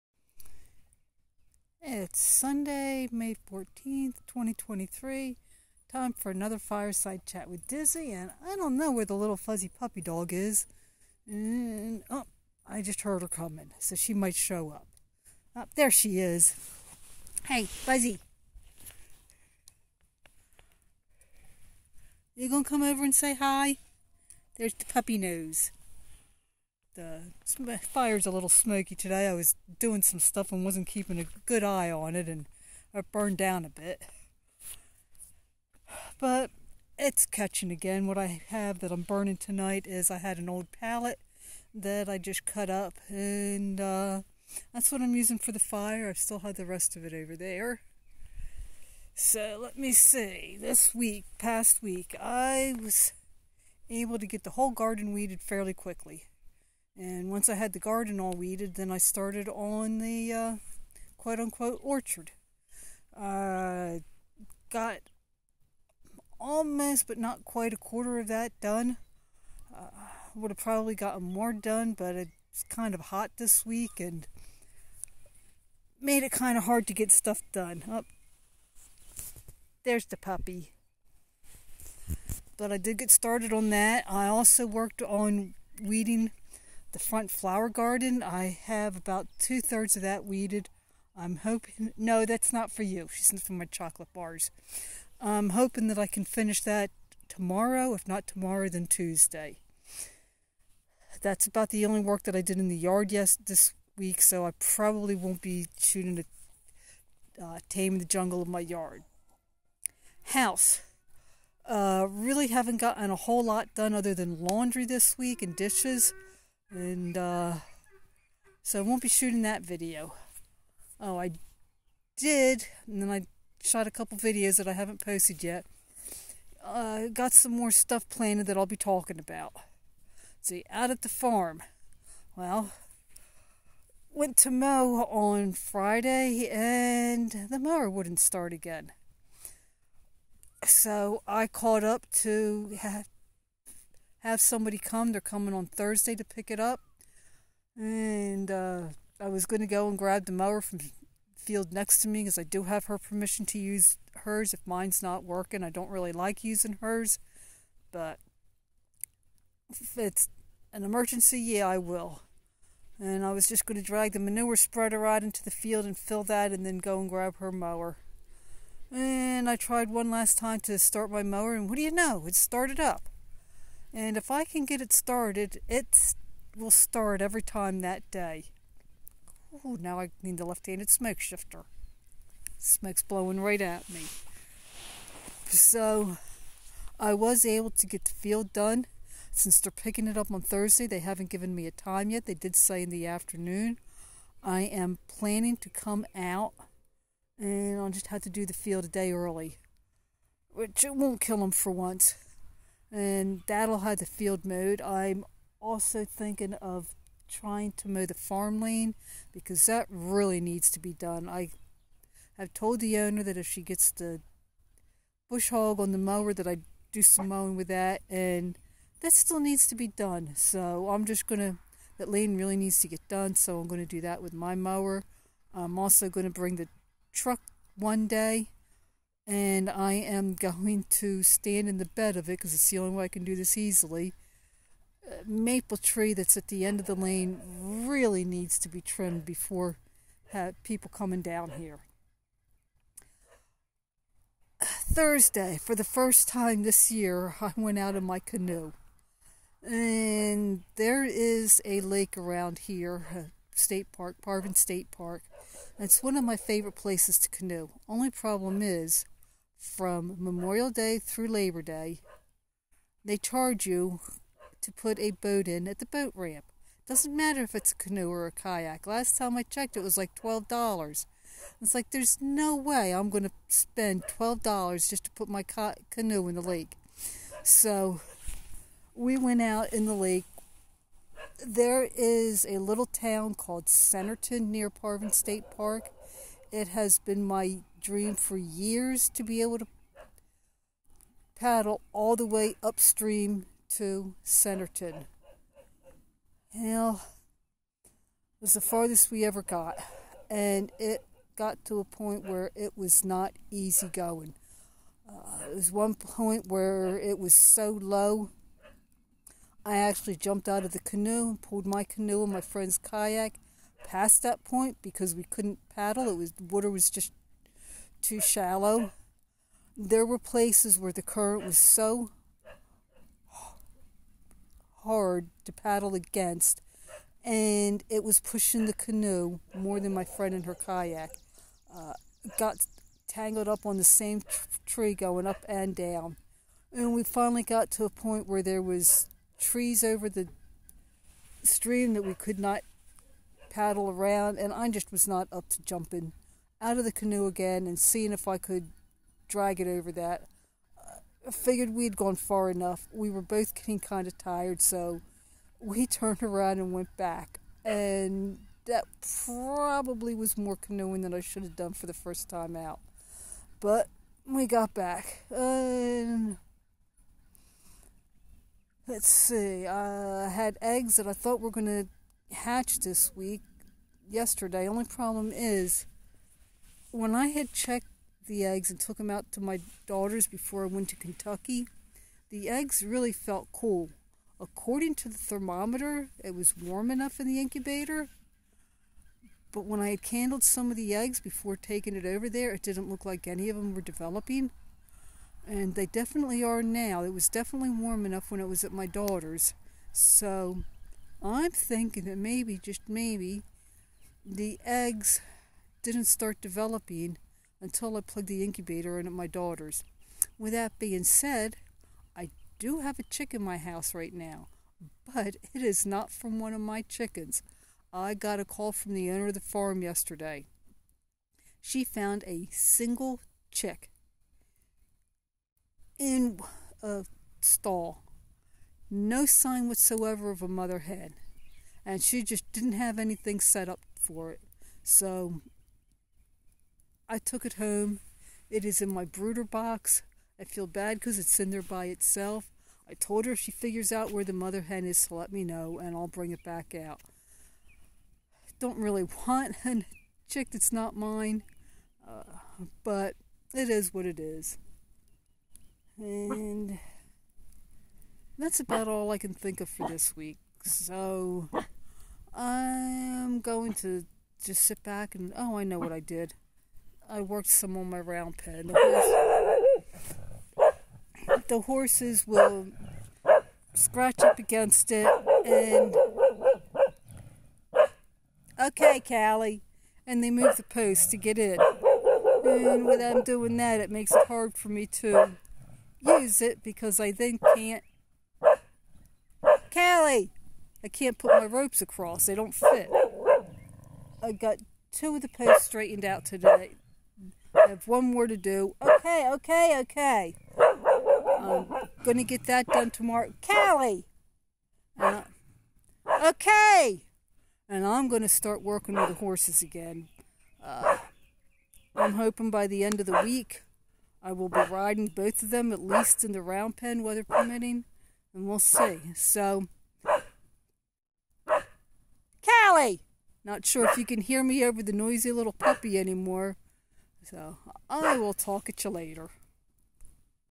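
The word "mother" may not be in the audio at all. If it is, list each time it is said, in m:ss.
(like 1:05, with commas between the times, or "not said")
7:10, 7:24.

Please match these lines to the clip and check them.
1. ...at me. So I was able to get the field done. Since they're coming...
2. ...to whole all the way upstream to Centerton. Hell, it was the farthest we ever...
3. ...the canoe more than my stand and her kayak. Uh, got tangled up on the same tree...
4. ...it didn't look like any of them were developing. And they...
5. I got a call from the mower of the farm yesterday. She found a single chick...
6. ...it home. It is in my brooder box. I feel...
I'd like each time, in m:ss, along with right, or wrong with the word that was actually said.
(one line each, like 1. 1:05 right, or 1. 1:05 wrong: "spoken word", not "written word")
1. 3:03 wrong: "picking", not "coming"
2. 4:49 wrong: "paddle", not "whole"
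3. 5:28 wrong: "friend", not "stand"
4. 6:32 right
5. 6:57 wrong: "owner", not "mower"
6. 7:17 right.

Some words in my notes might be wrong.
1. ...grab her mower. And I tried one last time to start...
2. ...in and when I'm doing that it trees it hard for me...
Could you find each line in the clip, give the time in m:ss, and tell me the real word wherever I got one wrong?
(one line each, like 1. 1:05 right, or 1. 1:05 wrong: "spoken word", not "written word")
1. 2:47 right
2. 8:01 wrong: "makes", not "trees".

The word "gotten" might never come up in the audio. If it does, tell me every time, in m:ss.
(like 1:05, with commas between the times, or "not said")
1:10, 1:52.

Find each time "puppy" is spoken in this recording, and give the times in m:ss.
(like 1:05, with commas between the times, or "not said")
0:09, 0:24, 1:20, 8:45.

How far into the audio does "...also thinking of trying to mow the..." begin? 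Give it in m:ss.
3:25.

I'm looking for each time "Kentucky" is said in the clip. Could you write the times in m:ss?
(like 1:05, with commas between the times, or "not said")
6:20.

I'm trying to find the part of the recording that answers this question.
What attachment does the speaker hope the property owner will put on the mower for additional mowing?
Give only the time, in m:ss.
3:35.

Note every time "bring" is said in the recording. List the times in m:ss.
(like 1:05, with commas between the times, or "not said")
3:46, 7:26.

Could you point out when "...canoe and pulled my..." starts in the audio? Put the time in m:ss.
5:10.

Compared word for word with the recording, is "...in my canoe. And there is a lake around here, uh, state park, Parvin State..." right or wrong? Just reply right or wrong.
right.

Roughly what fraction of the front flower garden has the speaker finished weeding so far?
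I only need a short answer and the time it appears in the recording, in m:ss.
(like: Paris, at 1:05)
two thirds, at 1:29.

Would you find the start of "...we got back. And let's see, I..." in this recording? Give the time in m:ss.
6:04.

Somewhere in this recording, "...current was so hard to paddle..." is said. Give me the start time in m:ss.
5:21.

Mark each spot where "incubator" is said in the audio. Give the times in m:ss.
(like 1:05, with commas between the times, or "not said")
6:27, 6:48.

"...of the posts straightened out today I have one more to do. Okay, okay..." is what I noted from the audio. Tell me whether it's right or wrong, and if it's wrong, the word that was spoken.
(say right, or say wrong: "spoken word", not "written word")
right.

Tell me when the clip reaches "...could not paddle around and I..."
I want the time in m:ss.
5:42.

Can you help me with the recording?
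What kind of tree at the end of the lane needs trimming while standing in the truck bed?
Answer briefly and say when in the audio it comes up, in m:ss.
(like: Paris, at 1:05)
maple, at 3:55.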